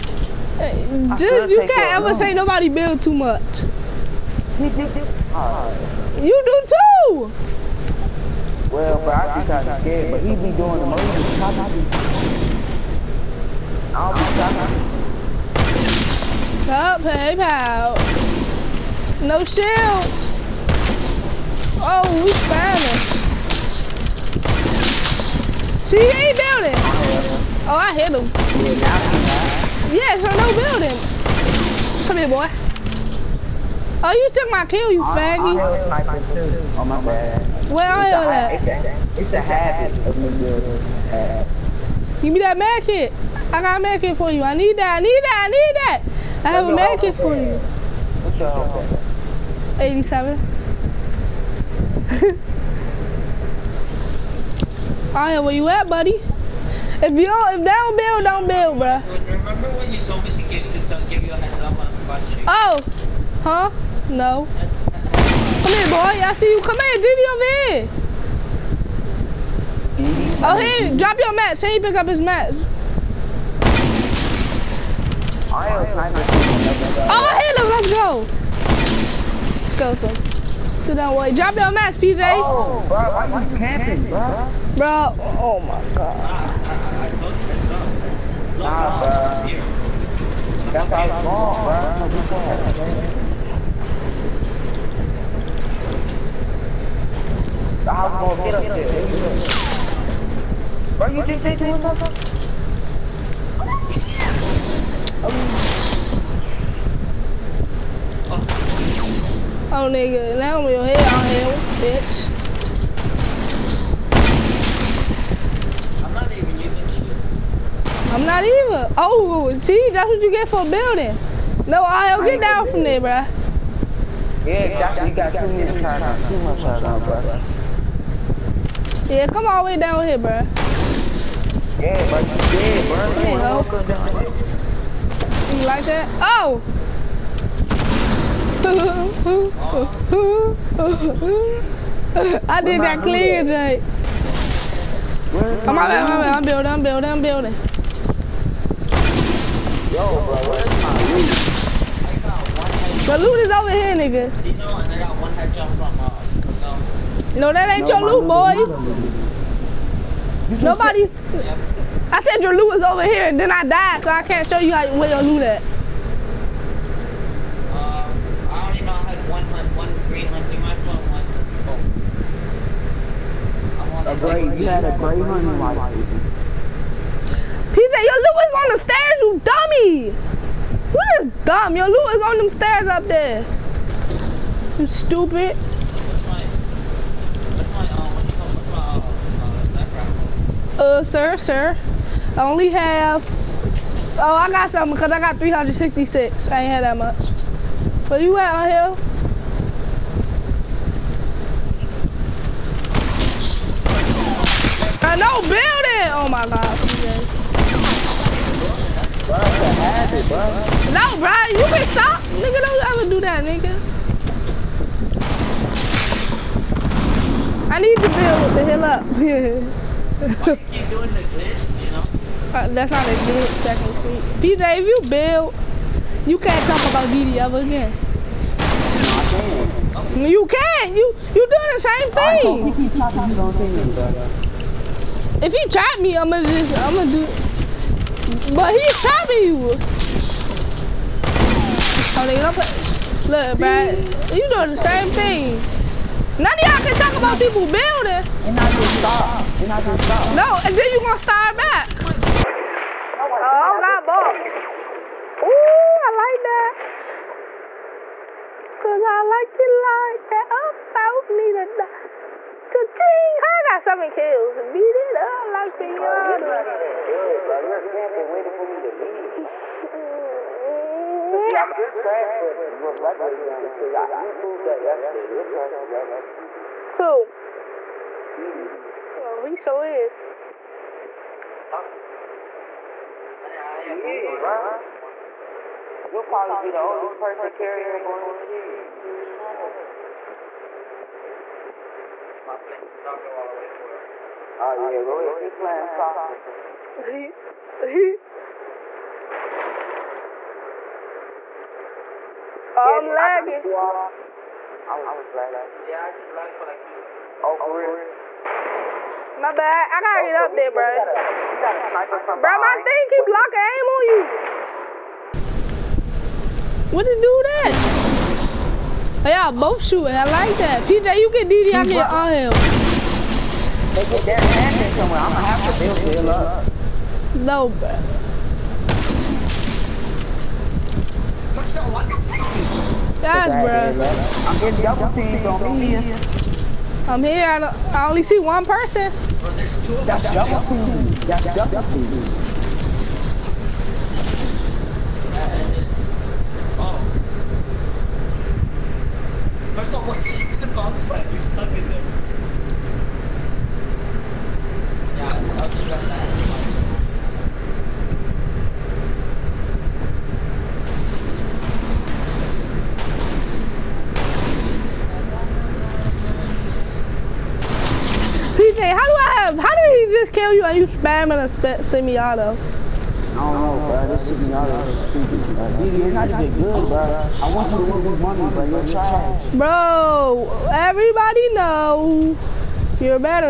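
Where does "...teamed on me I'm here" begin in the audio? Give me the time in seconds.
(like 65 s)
335 s.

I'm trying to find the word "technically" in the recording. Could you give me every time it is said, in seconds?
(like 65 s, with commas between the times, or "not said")
223 s.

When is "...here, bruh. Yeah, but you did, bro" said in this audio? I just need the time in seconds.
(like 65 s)
130 s.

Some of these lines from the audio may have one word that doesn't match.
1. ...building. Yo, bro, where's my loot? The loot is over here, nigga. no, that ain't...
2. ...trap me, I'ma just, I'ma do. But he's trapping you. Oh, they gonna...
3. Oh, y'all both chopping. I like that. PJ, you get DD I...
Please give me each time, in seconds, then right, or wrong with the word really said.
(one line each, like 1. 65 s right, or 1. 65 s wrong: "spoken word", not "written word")
1. 147 s right
2. 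235 s right
3. 319 s wrong: "shooting", not "chopping".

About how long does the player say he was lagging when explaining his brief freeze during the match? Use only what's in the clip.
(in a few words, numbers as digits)
two seconds.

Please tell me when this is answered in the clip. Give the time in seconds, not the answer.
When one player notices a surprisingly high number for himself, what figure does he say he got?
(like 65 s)
195 s.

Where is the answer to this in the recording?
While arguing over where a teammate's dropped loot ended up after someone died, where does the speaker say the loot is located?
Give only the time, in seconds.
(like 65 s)
178 s.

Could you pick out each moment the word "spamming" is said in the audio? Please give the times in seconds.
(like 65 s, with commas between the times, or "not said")
370 s.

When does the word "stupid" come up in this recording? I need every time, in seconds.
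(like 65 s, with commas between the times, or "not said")
184 s, 375 s.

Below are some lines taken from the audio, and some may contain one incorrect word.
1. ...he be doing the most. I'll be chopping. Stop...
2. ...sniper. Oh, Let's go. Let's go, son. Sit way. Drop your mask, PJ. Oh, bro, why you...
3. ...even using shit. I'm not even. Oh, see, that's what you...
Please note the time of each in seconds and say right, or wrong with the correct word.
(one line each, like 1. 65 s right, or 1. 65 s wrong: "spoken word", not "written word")
1. 10 s right
2. 75 s right
3. 116 s right.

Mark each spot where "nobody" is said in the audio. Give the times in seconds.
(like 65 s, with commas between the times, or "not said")
2 s, 160 s.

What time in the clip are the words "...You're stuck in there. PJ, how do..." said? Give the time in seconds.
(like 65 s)
351 s.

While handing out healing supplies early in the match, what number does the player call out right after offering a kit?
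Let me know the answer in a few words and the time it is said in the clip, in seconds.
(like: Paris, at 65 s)
87, at 49 s.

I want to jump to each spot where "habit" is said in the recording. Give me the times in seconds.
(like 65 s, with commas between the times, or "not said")
39 s, 209 s.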